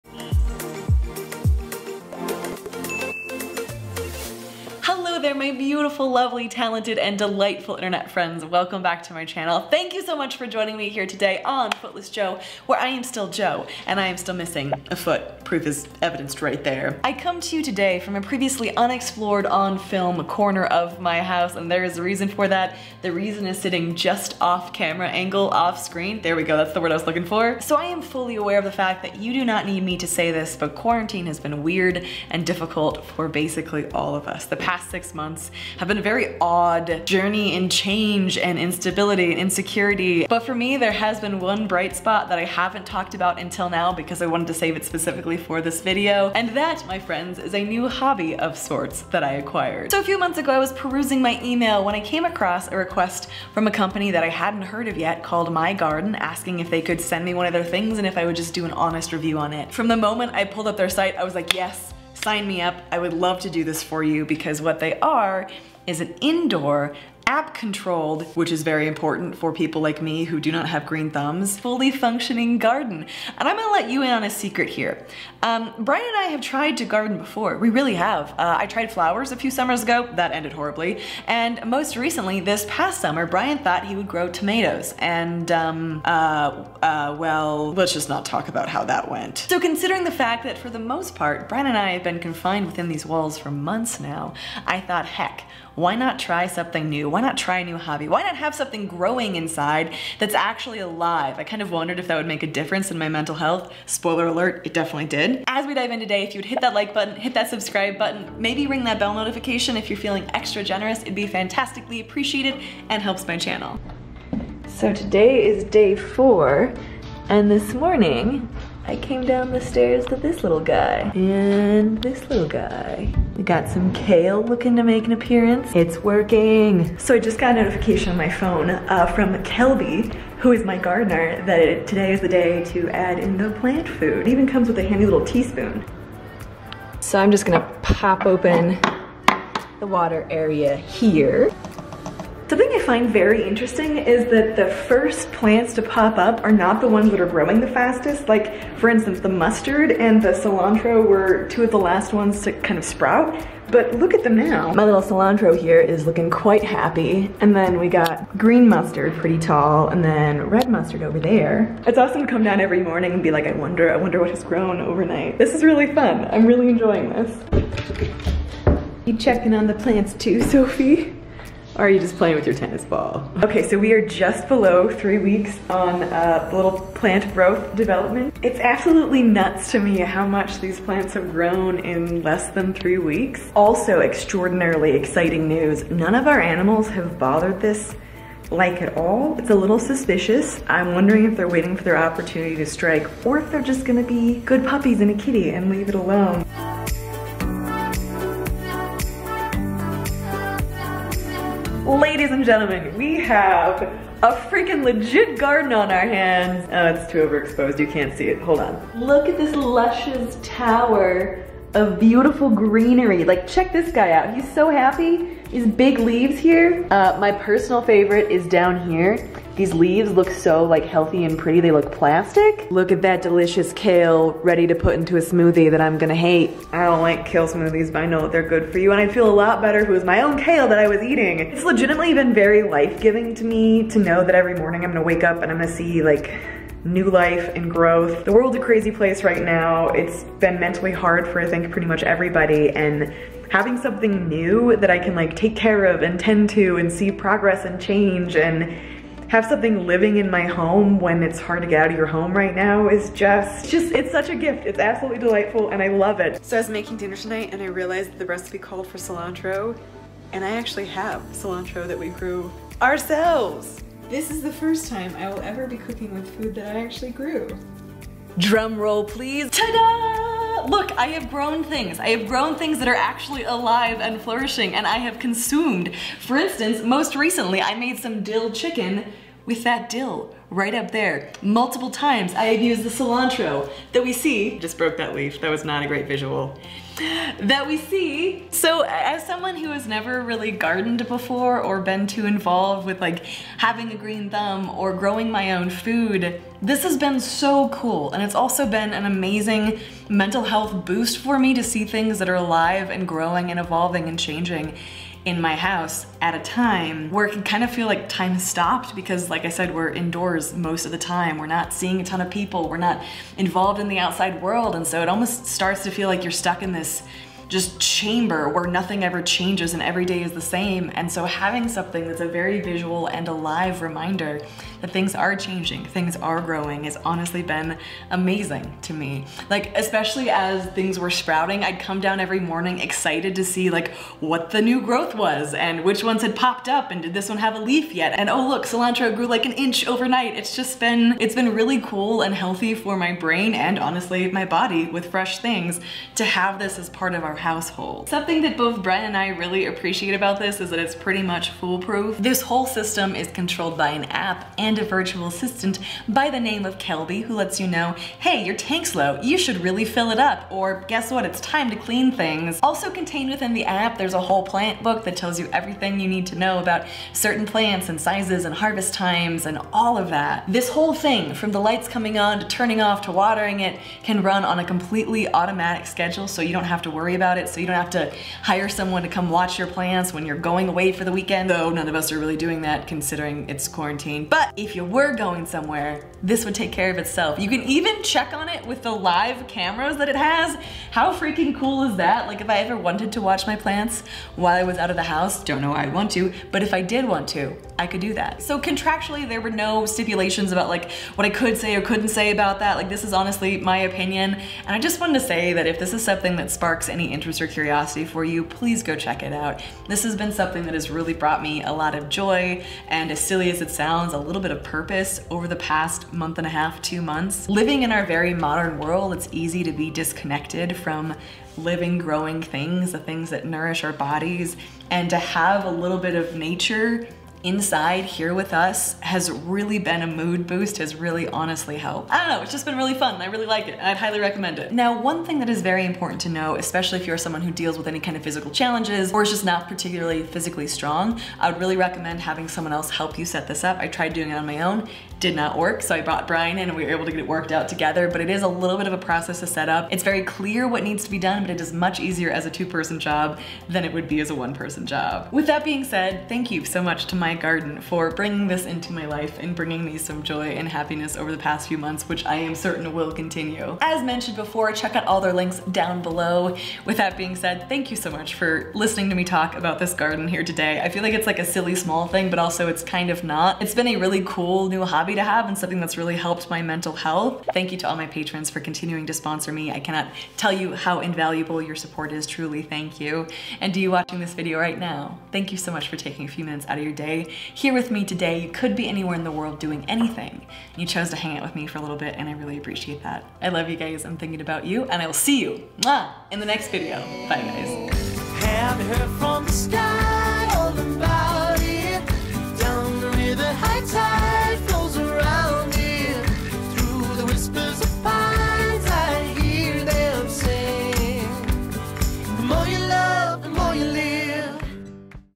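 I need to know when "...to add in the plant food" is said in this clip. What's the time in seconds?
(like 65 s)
132 s.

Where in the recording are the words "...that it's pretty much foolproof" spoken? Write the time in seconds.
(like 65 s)
350 s.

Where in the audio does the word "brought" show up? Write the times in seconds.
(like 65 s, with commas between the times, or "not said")
411 s, 446 s.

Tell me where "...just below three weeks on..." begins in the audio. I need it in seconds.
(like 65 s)
174 s.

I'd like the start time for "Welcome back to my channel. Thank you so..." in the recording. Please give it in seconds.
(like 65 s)
8 s.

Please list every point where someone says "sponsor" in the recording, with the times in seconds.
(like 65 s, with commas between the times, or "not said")
479 s.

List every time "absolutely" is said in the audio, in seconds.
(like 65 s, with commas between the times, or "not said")
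178 s, 254 s.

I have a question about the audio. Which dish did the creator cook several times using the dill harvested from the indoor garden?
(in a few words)
Dill chicken.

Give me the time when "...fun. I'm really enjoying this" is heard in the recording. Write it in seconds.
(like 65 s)
165 s.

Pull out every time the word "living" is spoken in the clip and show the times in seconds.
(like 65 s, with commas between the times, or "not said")
249 s, 417 s, 421 s.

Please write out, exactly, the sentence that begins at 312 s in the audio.
We're not involved in the outside world.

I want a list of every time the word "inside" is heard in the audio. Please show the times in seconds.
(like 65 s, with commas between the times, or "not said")
99 s, 427 s.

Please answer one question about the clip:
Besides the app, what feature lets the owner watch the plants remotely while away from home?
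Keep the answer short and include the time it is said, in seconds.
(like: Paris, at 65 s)
Live cameras, at 388 s.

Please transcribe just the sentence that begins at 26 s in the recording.
There we go, that's the word I was looking for.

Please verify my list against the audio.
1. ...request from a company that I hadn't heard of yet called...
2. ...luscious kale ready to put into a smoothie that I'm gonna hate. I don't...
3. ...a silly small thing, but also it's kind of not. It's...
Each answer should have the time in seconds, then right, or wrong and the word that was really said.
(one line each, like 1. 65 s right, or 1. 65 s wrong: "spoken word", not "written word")
1. 52 s right
2. 223 s wrong: "delicious", not "luscious"
3. 471 s right.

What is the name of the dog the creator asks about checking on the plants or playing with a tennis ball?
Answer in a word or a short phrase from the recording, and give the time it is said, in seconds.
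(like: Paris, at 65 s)
Sophie, at 170 s.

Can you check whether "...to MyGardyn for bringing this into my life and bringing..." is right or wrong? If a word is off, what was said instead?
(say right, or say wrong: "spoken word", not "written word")
right.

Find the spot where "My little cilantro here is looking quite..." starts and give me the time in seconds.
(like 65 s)
154 s.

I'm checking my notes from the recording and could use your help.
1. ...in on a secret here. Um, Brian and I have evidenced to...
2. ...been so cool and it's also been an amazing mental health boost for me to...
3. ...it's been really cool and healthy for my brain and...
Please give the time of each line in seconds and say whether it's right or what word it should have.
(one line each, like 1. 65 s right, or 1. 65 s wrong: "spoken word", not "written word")
1. 74 s wrong: "tried", not "evidenced"
2. 296 s right
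3. 341 s right.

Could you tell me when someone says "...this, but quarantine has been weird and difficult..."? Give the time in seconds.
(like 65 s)
30 s.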